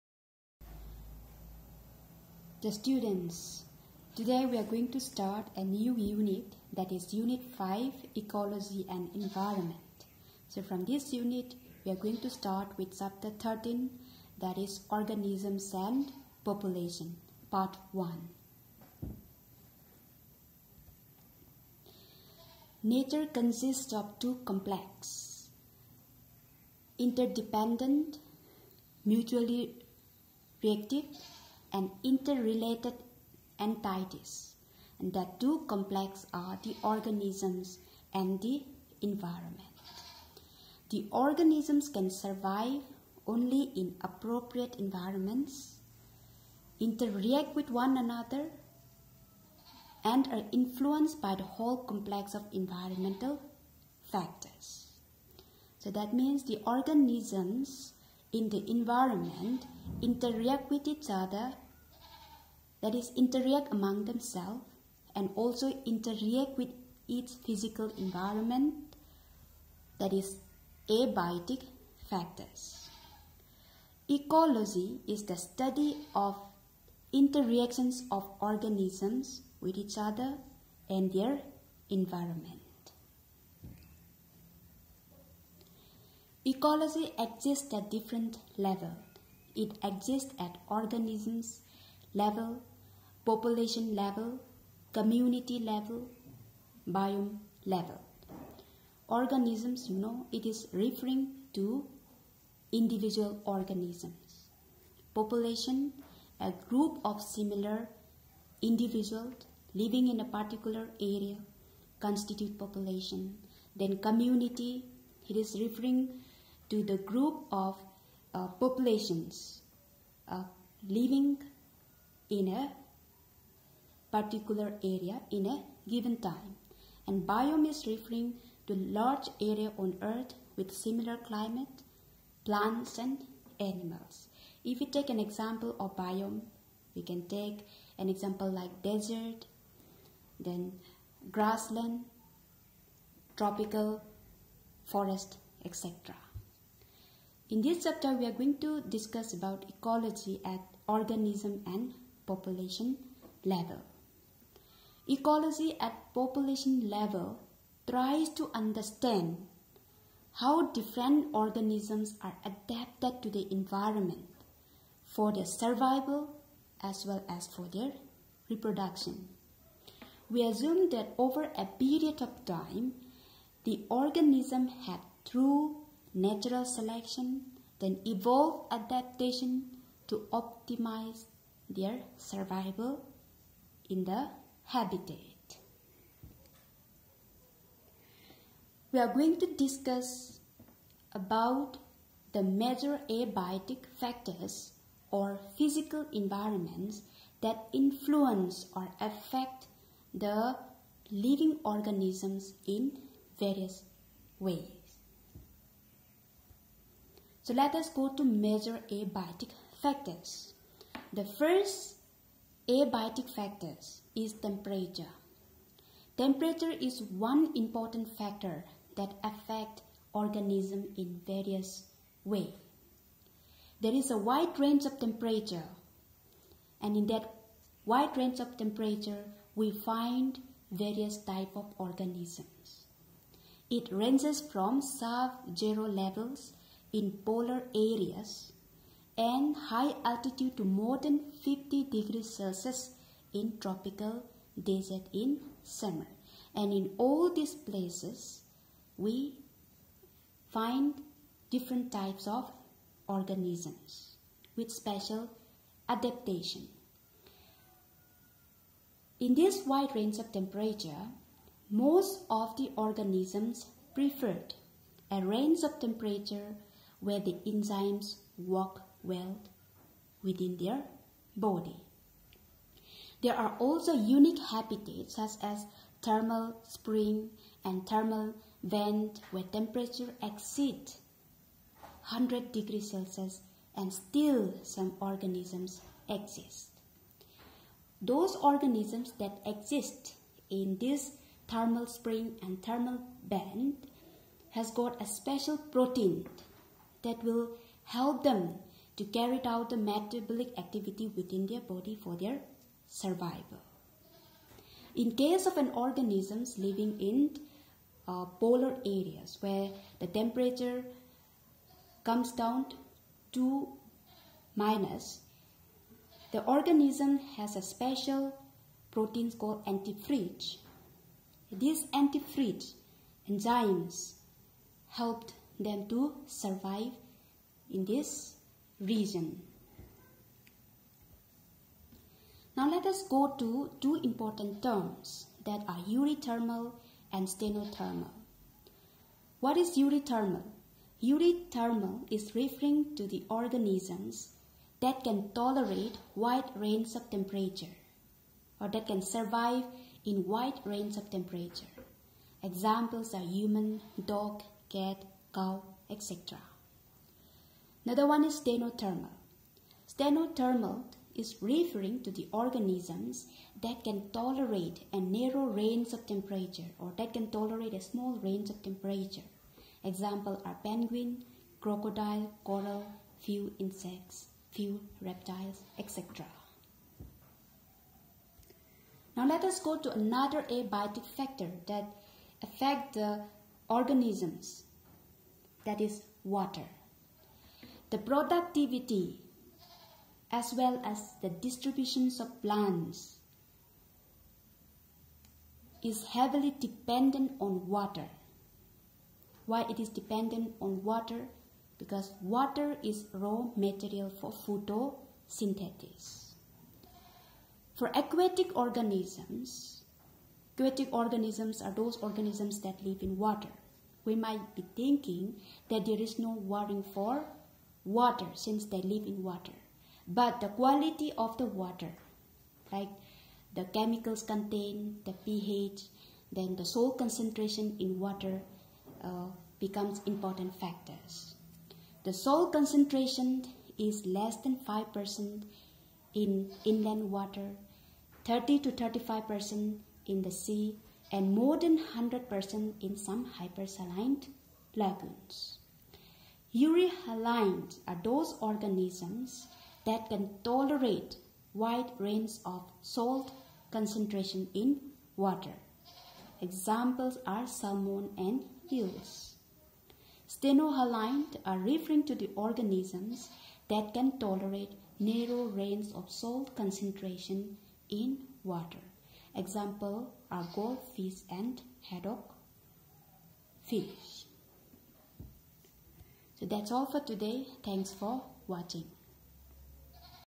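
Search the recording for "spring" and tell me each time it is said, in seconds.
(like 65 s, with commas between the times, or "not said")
276 s, 291 s.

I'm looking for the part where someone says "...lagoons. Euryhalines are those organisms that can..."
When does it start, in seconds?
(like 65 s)
444 s.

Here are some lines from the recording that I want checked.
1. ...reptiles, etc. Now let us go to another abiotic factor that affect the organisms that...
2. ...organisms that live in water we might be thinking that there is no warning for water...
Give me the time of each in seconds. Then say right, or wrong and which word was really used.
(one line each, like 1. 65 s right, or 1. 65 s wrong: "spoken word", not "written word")
1. 375 s right
2. 411 s right.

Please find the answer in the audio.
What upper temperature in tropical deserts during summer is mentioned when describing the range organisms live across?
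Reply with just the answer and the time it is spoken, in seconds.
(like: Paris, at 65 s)
50 degrees Celsius, at 241 s.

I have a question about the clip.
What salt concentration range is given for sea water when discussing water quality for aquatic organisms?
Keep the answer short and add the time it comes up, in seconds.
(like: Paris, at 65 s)
30 to 35%, at 438 s.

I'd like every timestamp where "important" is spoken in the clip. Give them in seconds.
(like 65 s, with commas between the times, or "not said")
217 s, 334 s, 430 s.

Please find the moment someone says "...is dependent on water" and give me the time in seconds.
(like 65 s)
399 s.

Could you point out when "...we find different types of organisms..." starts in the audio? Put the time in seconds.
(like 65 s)
248 s.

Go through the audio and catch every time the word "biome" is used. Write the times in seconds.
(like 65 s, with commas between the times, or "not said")
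96 s, 127 s, 135 s.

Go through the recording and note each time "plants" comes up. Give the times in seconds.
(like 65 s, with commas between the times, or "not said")
132 s, 392 s.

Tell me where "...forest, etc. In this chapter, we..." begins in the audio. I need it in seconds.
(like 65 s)
144 s.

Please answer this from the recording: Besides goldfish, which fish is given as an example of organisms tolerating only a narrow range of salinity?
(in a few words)
Haddock.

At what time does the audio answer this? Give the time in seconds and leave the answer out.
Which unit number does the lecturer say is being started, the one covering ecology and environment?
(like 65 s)
7 s.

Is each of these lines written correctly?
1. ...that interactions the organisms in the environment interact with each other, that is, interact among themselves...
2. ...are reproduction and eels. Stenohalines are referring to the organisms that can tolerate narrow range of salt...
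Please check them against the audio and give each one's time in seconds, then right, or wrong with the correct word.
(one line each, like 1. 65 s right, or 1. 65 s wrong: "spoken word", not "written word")
1. 55 s wrong: "means", not "interactions"
2. 457 s wrong: "salmon", not "reproduction".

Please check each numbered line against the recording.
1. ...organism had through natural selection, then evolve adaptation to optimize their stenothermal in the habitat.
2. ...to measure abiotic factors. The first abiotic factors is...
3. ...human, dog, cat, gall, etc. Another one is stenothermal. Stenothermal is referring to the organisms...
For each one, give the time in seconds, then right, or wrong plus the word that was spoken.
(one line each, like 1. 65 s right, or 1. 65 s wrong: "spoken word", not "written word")
1. 173 s wrong: "survival", not "stenothermal"
2. 208 s right
3. 353 s right.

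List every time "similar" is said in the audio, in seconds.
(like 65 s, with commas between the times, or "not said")
107 s, 130 s.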